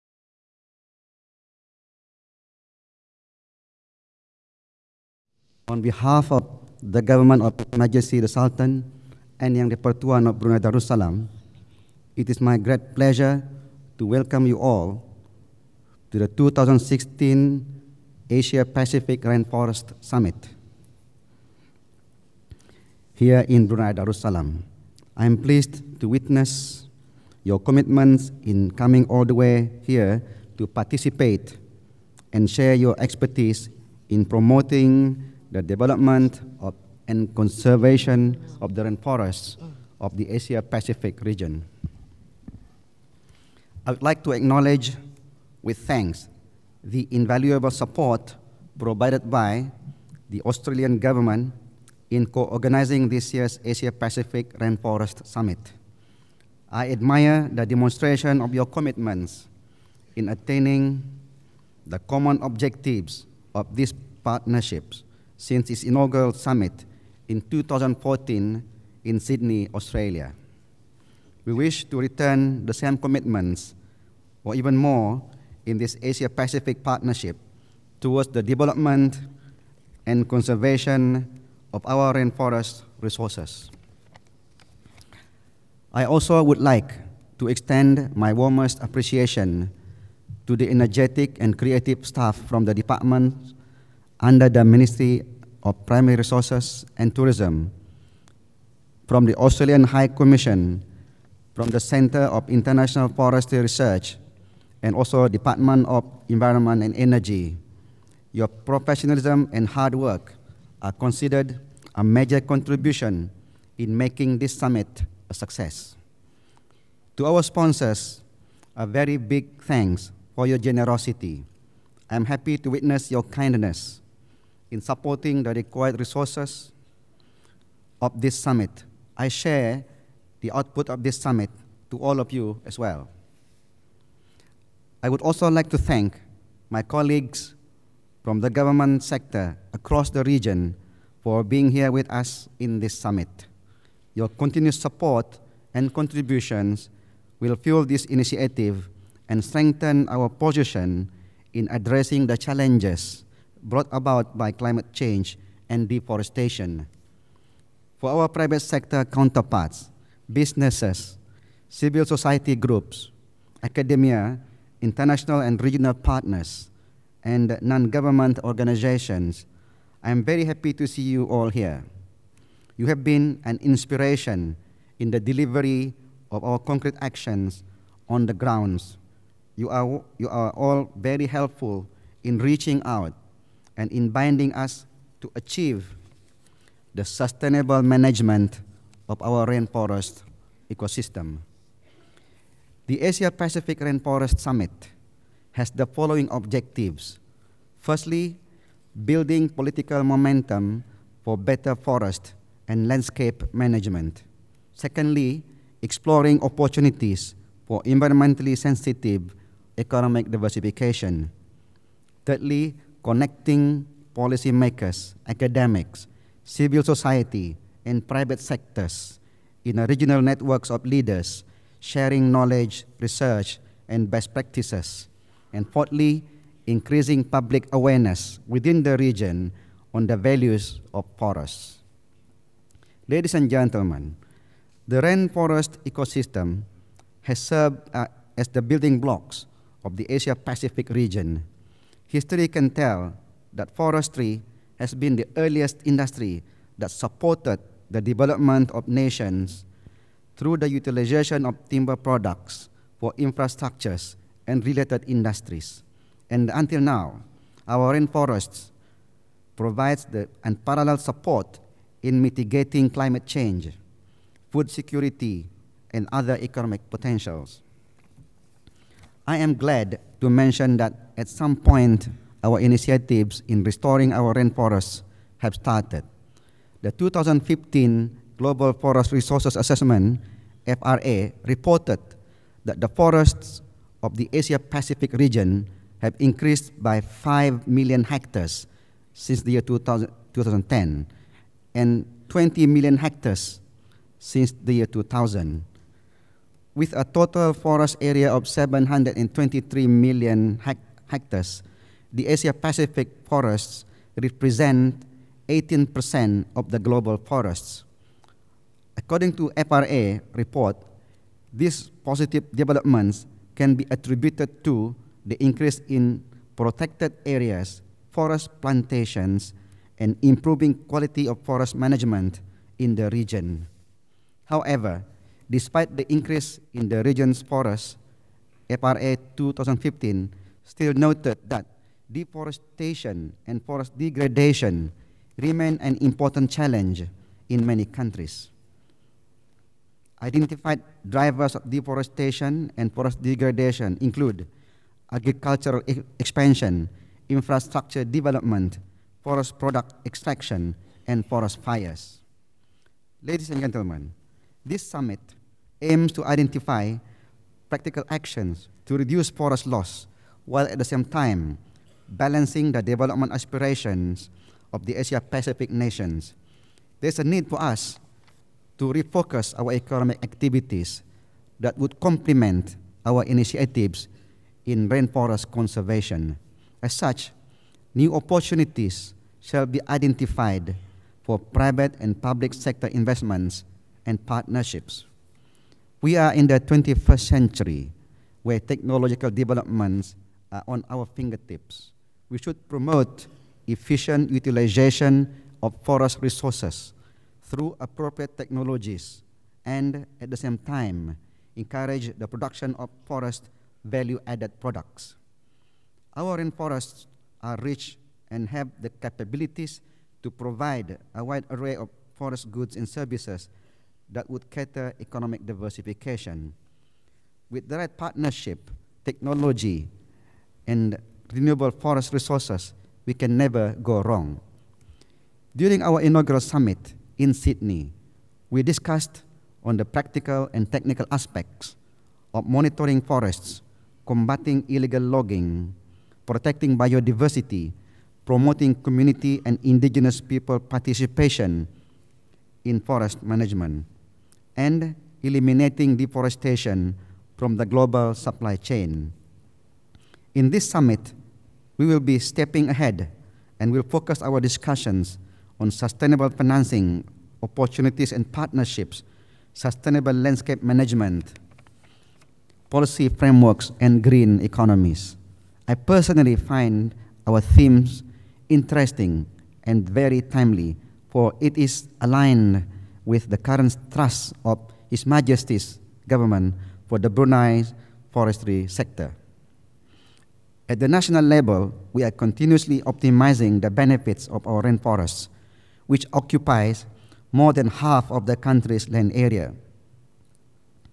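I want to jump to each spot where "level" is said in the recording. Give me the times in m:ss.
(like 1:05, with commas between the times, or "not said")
8:01.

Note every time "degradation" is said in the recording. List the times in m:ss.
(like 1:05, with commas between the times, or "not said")
5:33, 5:43.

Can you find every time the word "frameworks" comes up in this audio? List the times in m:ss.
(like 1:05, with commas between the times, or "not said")
7:43.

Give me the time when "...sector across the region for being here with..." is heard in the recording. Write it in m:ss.
2:19.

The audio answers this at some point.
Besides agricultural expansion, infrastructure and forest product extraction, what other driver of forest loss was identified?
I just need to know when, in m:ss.
5:51.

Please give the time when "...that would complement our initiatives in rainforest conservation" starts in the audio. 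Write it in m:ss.
6:11.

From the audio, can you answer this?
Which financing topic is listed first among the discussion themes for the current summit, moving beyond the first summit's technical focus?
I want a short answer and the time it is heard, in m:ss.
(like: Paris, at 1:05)
sustainable financing, at 7:35.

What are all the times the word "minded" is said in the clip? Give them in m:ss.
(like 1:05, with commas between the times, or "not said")
not said.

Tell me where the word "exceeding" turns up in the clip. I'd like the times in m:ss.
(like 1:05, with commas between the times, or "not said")
not said.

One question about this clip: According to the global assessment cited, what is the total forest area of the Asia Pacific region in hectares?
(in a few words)
723 million hectares.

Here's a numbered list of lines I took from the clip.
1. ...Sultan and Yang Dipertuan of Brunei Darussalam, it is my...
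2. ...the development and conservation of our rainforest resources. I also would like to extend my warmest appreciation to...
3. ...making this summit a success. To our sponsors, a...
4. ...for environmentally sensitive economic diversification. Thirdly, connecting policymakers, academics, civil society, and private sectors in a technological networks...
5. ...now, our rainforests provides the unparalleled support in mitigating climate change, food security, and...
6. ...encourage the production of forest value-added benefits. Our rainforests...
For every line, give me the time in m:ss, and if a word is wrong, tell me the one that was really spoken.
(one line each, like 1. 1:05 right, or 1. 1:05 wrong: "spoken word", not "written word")
1. 0:08 right
2. 1:18 right
3. 1:53 right
4. 3:27 wrong: "regional", not "technological"
5. 4:16 right
6. 6:41 wrong: "products", not "benefits".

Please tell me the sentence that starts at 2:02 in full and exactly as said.
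I'm happy to witness your kindness in supporting the required resources of this summit.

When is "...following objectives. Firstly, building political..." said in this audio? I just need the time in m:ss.
3:15.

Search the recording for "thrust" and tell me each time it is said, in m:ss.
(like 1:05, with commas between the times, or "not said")
7:53.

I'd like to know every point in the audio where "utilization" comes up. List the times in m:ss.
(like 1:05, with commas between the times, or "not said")
4:10, 6:34.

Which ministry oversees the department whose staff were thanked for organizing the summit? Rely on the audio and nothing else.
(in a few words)
Ministry of Primary Resources and Tourism.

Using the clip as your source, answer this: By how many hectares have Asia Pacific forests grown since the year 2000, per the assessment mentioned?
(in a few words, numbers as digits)
20 million hectares.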